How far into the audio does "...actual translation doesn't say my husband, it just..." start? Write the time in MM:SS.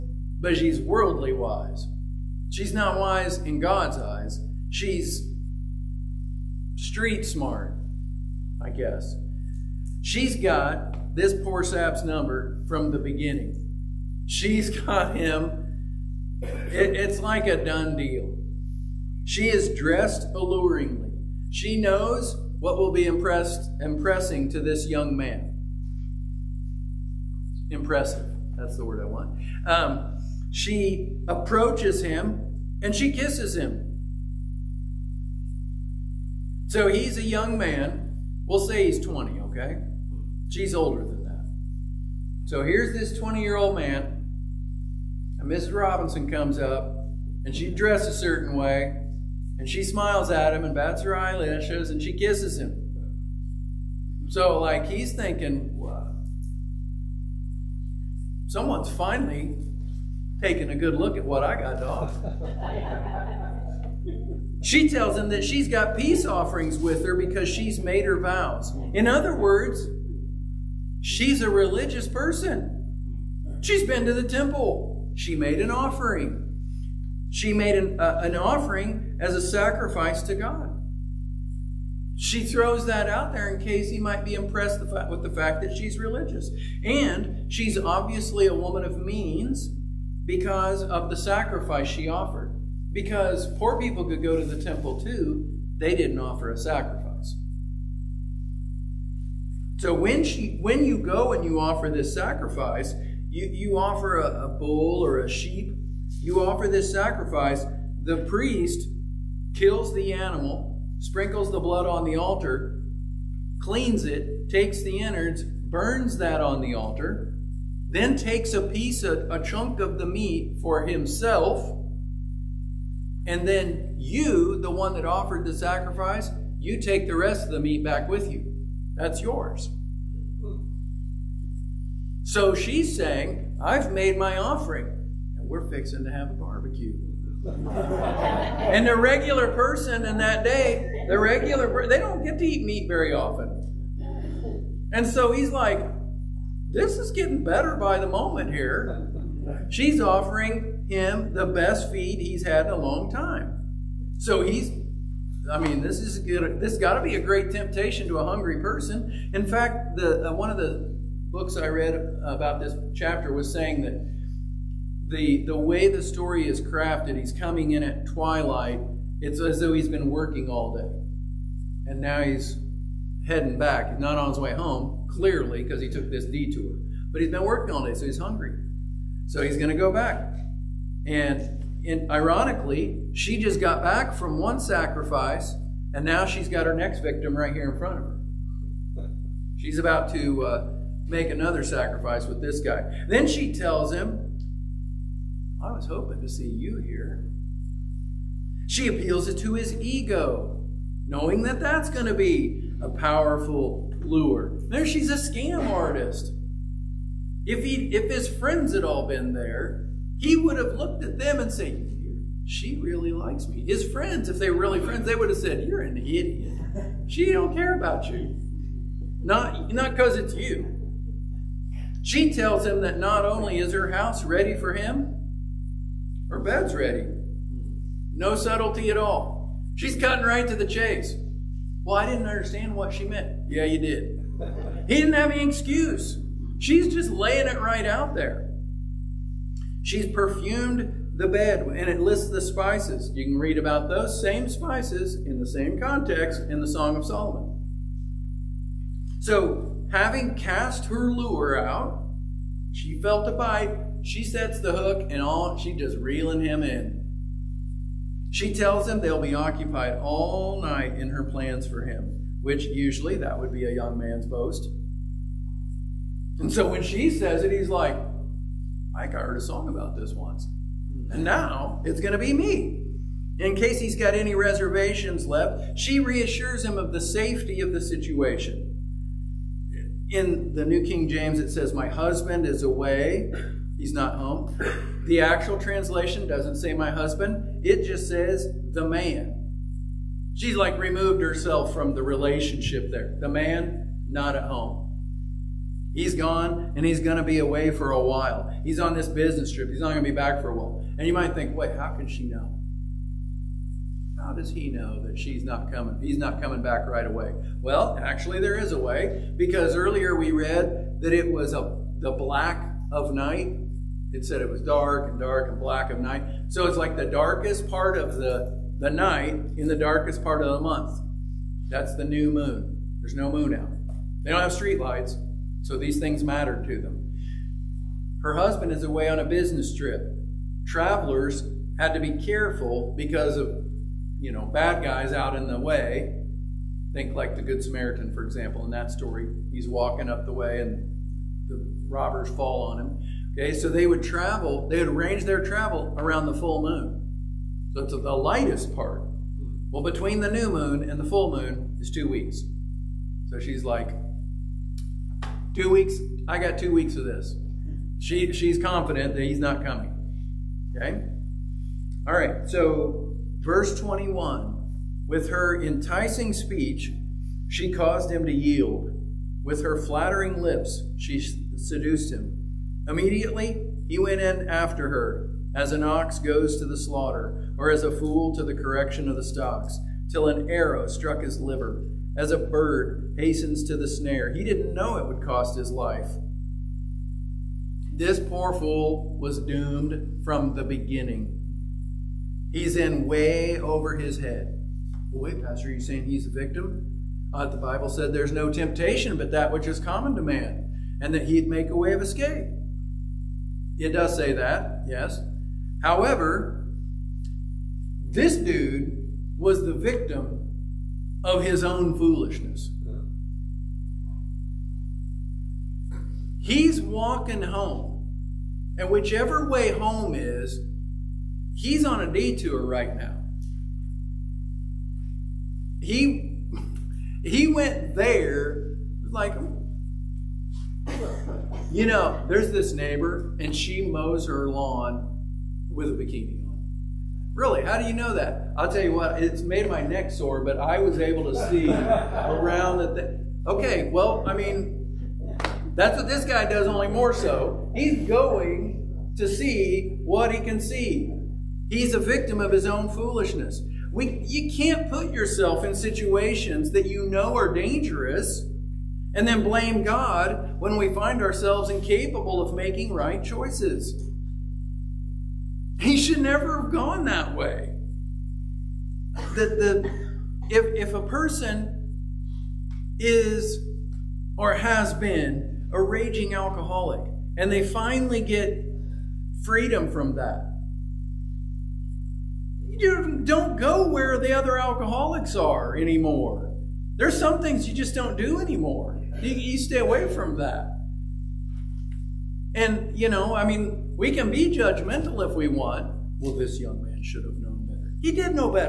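04:45.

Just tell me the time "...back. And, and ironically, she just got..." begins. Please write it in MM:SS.
02:59.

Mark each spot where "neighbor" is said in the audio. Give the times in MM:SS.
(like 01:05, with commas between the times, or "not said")
07:12.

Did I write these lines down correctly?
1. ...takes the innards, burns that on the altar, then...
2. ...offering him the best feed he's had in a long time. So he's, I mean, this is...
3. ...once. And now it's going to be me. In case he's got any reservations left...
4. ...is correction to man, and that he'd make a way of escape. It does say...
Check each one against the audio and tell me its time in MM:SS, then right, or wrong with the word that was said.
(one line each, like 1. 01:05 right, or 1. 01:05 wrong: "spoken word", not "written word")
1. 01:54 right
2. 02:30 right
3. 04:30 right
4. 06:39 wrong: "common", not "correction".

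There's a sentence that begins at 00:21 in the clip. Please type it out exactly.
She knows what will be impressed, impressing to this young man.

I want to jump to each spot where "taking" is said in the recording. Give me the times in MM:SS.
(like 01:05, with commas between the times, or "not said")
01:00.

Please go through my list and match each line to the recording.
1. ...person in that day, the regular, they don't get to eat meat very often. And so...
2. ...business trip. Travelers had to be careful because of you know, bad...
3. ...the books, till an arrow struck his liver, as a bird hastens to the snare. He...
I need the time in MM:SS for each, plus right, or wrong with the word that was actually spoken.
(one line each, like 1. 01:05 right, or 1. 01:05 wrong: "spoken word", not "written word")
1. 02:19 right
2. 05:29 right
3. 06:19 wrong: "stocks", not "books".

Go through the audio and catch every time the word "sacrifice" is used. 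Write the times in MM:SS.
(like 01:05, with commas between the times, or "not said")
01:19, 01:31, 01:36, 01:42, 01:46, 02:05, 03:04, 03:11.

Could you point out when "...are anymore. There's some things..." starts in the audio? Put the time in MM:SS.
08:05.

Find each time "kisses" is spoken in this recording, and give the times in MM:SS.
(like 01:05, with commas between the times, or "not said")
00:33, 00:52.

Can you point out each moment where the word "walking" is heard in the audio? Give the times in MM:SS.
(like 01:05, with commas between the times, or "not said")
05:39, 06:56.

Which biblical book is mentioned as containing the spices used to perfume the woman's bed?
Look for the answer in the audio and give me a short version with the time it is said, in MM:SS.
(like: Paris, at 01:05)
Song of Solomon, at 04:06.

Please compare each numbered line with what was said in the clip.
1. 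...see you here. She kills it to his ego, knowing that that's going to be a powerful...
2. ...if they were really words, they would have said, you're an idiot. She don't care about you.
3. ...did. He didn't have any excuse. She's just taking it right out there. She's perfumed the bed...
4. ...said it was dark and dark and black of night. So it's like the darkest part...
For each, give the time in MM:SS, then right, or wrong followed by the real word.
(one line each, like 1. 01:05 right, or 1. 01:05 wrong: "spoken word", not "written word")
1. 03:16 wrong: "appeals", not "kills"
2. 03:34 wrong: "friends", not "words"
3. 03:53 wrong: "laying", not "taking"
4. 05:14 right.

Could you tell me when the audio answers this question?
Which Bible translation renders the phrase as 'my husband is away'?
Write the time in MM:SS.
04:40.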